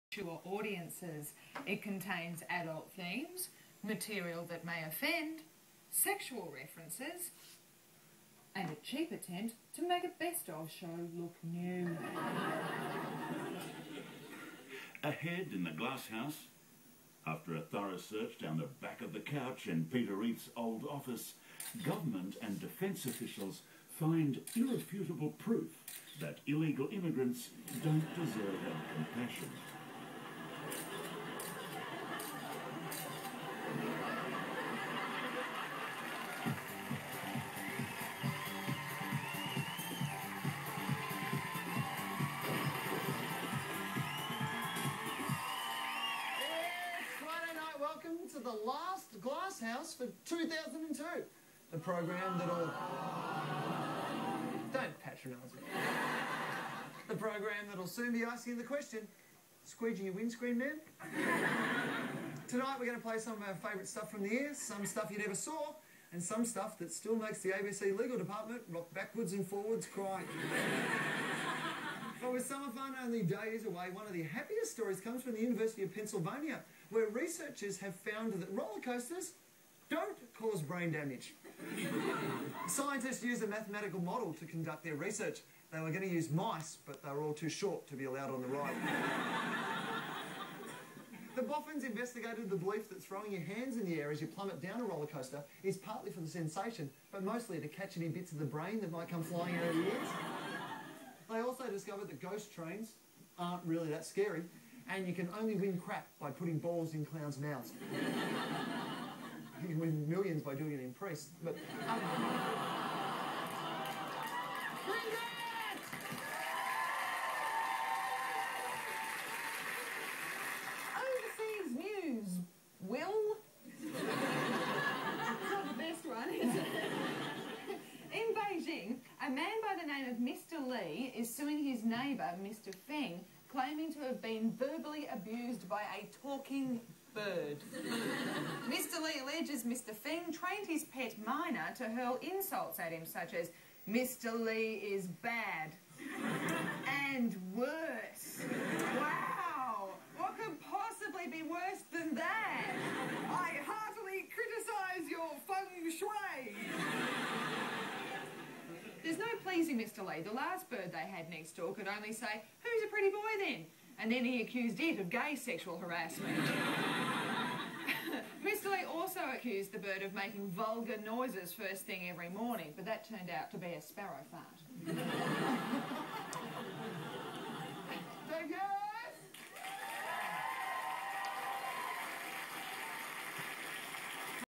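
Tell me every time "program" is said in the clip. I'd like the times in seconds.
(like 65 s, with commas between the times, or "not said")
51 s, 57 s.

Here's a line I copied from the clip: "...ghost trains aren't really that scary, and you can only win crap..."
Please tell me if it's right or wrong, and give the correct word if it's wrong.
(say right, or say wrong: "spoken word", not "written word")
right.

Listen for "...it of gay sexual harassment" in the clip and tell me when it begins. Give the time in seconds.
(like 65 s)
164 s.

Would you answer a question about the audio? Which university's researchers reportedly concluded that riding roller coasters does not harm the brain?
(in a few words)
University of Pennsylvania.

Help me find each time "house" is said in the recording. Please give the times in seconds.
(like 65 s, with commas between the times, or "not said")
16 s, 49 s.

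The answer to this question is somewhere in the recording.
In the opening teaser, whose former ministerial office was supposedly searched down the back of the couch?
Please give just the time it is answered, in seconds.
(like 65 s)
19 s.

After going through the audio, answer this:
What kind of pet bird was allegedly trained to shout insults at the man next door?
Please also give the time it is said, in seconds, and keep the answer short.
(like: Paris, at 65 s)
myna, at 141 s.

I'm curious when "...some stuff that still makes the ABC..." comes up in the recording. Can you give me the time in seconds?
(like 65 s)
66 s.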